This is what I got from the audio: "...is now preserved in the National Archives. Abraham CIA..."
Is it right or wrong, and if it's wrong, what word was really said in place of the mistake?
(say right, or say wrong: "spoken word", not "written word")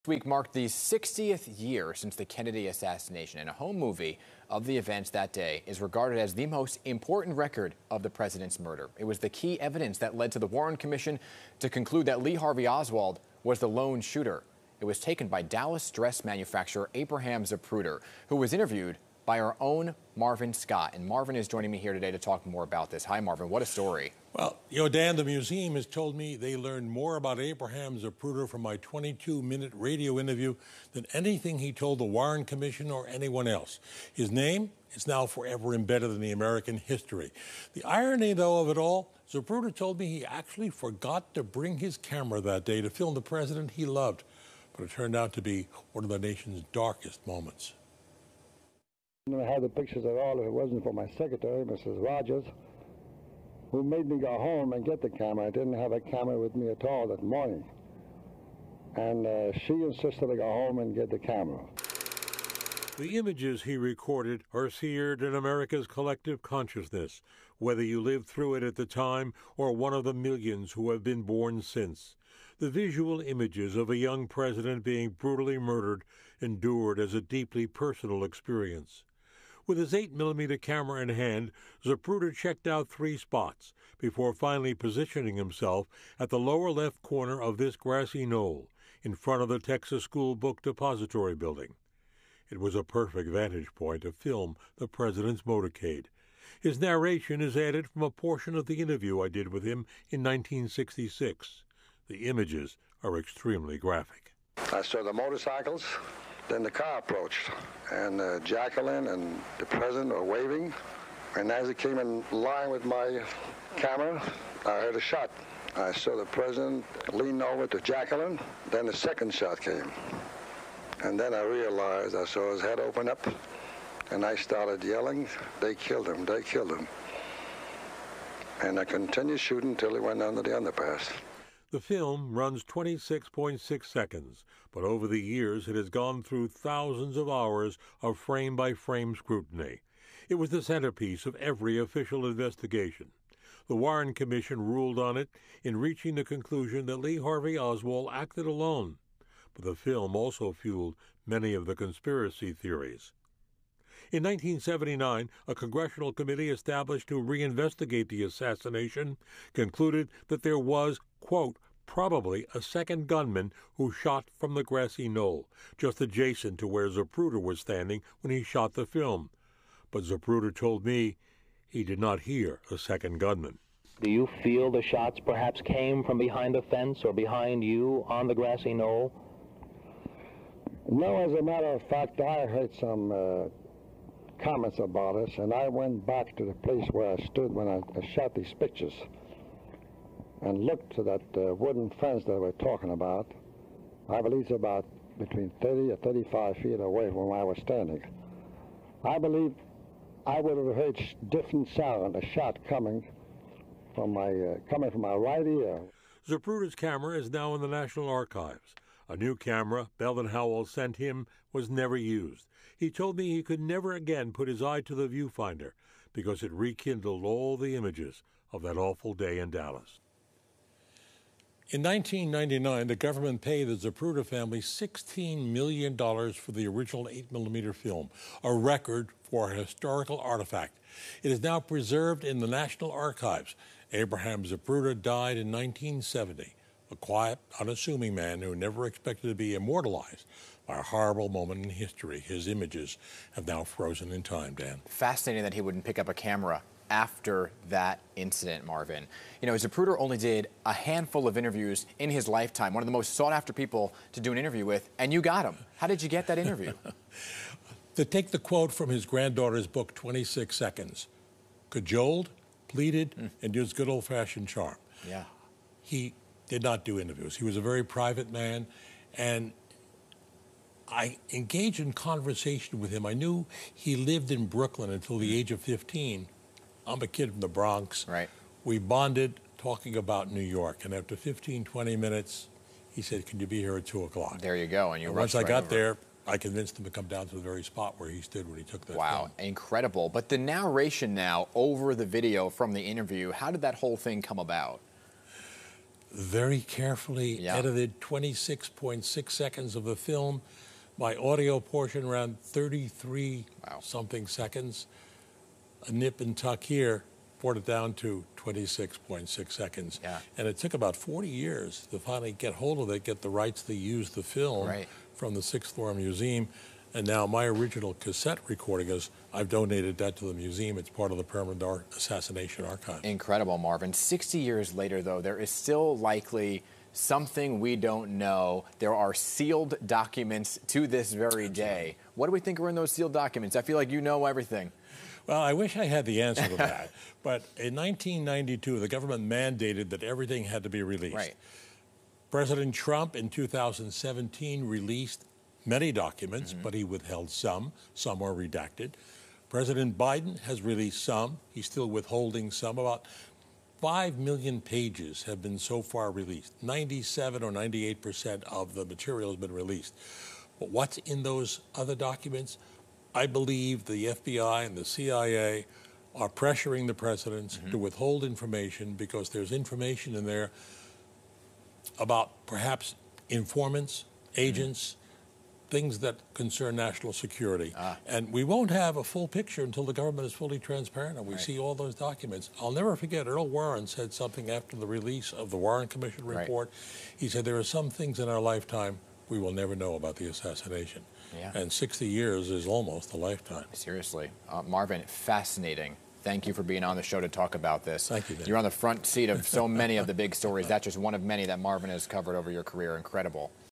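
wrong: "Zapruder", not "CIA".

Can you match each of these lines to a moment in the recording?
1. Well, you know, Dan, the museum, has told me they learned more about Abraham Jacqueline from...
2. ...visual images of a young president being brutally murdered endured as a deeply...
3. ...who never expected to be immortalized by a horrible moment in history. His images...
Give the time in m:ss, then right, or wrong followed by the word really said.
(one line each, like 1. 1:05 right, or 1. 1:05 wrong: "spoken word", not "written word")
1. 0:24 wrong: "Zapruder", not "Jacqueline"
2. 1:12 right
3. 3:58 right.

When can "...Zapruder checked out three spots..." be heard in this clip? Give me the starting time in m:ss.
1:21.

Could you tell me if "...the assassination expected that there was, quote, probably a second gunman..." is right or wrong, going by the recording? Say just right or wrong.
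wrong.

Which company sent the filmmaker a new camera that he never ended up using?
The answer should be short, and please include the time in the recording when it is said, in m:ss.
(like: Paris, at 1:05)
Bell and Howell, at 3:29.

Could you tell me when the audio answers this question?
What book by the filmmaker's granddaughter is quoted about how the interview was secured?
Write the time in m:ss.
4:19.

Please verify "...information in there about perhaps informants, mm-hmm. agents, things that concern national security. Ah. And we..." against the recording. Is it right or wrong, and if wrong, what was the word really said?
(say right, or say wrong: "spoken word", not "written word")
right.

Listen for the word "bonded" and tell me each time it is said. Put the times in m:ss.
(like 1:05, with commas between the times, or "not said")
4:38.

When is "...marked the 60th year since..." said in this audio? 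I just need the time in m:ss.
0:00.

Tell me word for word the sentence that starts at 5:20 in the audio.
It's part of the Permanent Ar Assassination Archive.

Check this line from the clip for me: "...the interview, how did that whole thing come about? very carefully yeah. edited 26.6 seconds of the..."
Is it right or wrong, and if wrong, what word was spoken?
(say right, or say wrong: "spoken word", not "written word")
right.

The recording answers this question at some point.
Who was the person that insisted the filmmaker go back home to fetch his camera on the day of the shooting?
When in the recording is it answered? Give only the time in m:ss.
0:51.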